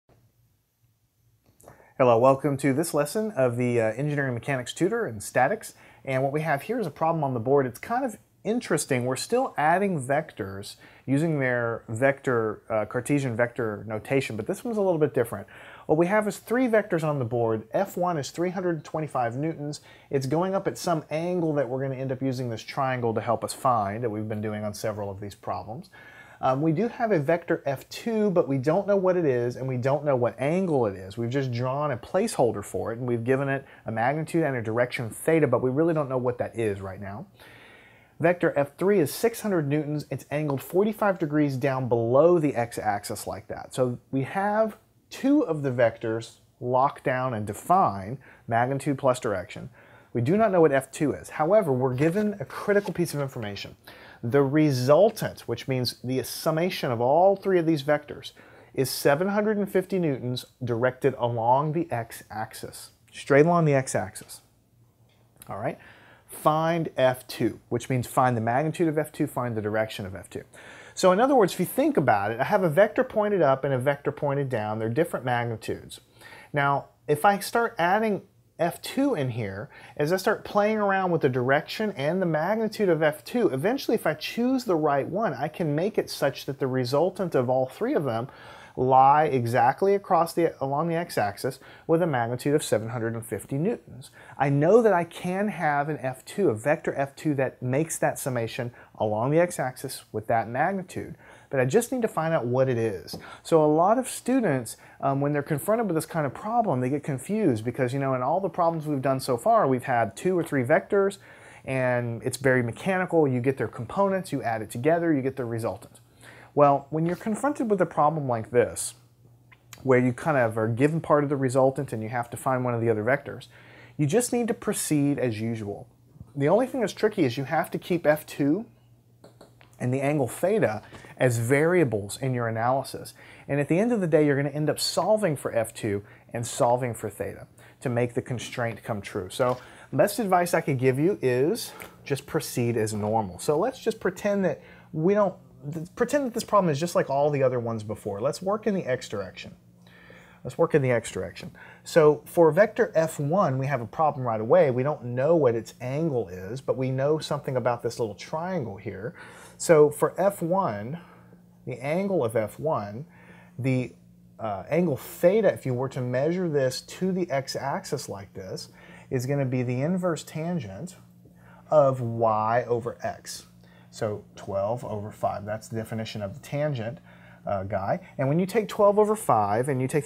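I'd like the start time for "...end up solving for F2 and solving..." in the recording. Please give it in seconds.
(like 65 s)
134 s.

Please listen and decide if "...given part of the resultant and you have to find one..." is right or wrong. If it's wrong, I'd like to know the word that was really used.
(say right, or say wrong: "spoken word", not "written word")
right.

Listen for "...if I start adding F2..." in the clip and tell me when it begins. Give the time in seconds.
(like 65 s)
77 s.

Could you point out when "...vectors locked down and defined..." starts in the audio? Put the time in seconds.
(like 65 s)
45 s.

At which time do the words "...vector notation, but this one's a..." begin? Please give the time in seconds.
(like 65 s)
13 s.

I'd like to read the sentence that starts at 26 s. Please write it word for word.
Um, we do have a vector F2, but we don't know what it is and we don't know what angle it is.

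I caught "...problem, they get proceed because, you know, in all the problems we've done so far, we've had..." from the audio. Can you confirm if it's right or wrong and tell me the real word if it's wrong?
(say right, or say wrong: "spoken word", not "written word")
wrong: "confused", not "proceed".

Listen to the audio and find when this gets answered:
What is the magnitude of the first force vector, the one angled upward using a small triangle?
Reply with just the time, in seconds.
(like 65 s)
18 s.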